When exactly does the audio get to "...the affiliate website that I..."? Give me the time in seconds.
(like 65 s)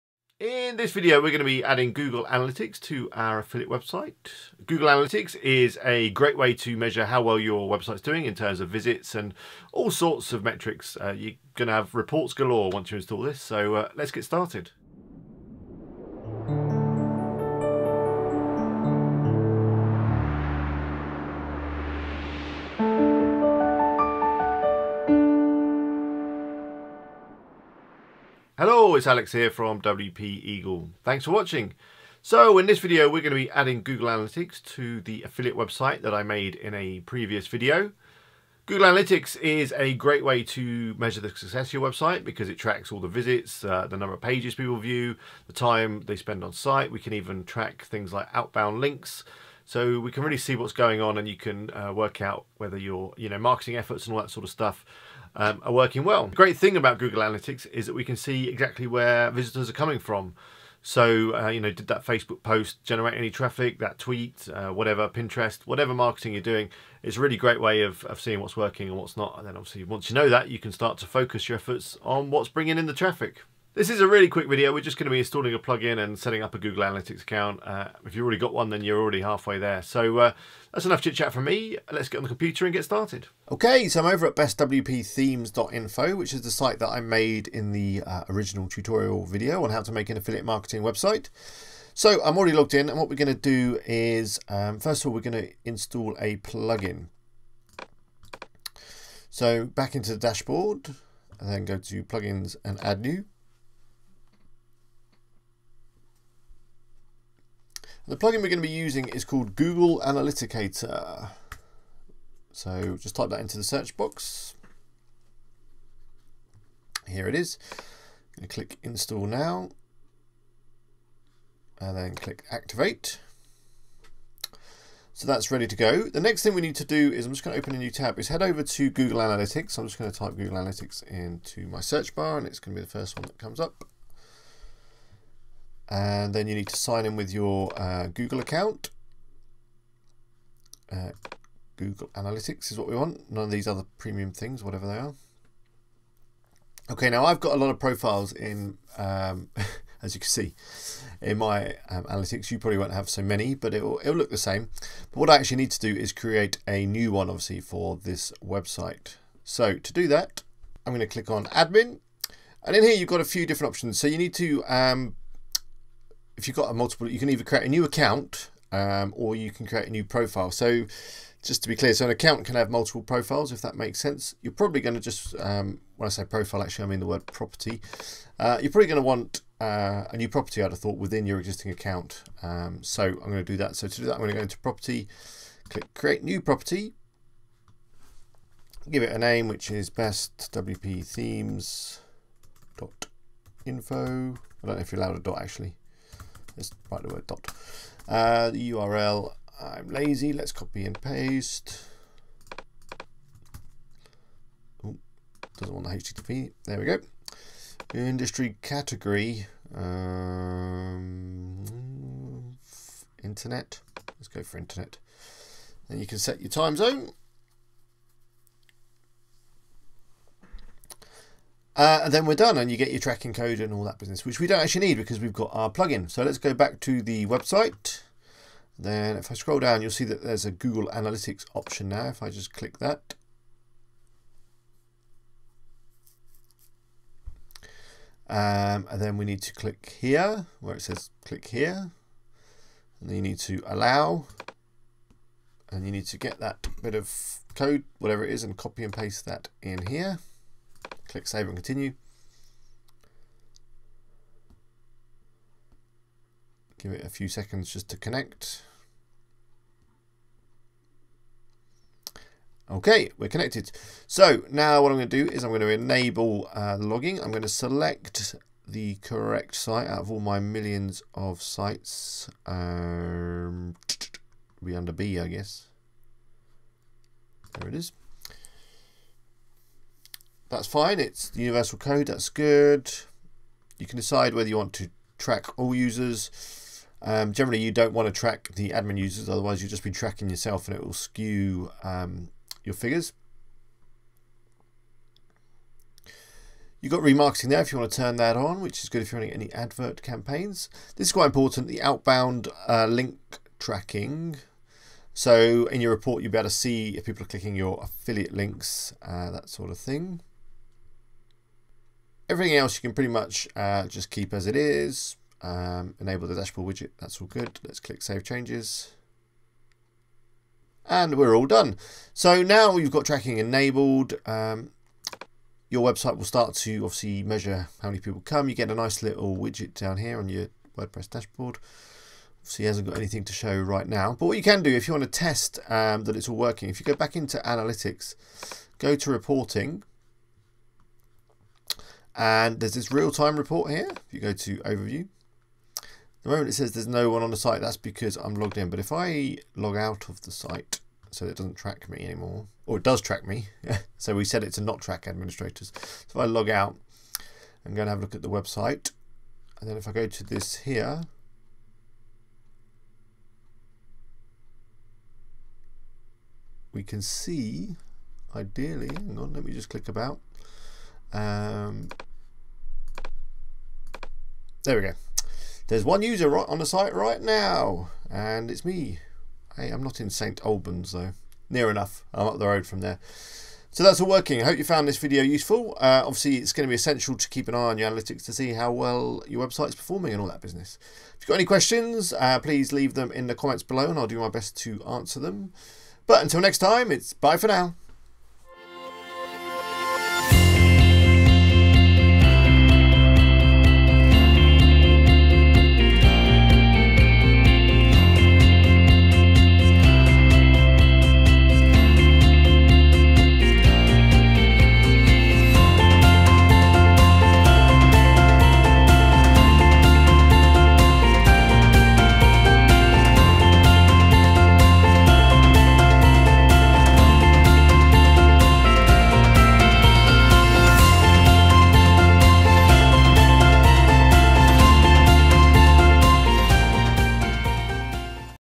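34 s.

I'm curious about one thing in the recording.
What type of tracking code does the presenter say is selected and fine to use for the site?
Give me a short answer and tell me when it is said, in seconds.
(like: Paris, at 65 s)
Universal code, at 281 s.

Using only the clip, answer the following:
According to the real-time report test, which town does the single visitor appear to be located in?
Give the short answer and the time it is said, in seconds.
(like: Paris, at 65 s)
St. Albans, at 380 s.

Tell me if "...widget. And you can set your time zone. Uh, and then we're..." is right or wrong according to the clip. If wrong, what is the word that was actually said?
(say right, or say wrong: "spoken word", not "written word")
wrong: "internet", not "widget".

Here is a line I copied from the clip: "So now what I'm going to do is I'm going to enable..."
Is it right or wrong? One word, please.
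right.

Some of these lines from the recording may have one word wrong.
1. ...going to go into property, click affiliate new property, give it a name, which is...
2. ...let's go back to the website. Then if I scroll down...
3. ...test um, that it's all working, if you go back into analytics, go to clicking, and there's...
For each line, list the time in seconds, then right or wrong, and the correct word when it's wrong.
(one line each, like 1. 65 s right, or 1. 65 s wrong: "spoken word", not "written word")
1. 184 s wrong: "create", not "affiliate"
2. 226 s right
3. 335 s wrong: "reporting", not "clicking".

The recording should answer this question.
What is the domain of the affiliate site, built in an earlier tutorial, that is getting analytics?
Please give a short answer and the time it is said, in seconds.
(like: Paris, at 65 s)
bestwpthemes.info, at 84 s.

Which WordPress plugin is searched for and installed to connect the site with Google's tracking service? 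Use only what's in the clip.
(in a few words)
Google Analyticator.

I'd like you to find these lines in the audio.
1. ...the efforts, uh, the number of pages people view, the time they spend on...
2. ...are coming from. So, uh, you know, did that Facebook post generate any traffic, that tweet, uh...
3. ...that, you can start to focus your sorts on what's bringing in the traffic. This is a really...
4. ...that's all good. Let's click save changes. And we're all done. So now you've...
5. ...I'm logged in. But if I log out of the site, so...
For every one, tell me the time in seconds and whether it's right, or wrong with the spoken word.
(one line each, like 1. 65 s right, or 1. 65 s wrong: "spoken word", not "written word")
1. 42 s wrong: "visits", not "efforts"
2. 59 s right
3. 70 s wrong: "efforts", not "sorts"
4. 316 s right
5. 348 s right.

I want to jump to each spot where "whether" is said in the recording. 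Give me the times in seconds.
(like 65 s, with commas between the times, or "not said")
52 s, 284 s.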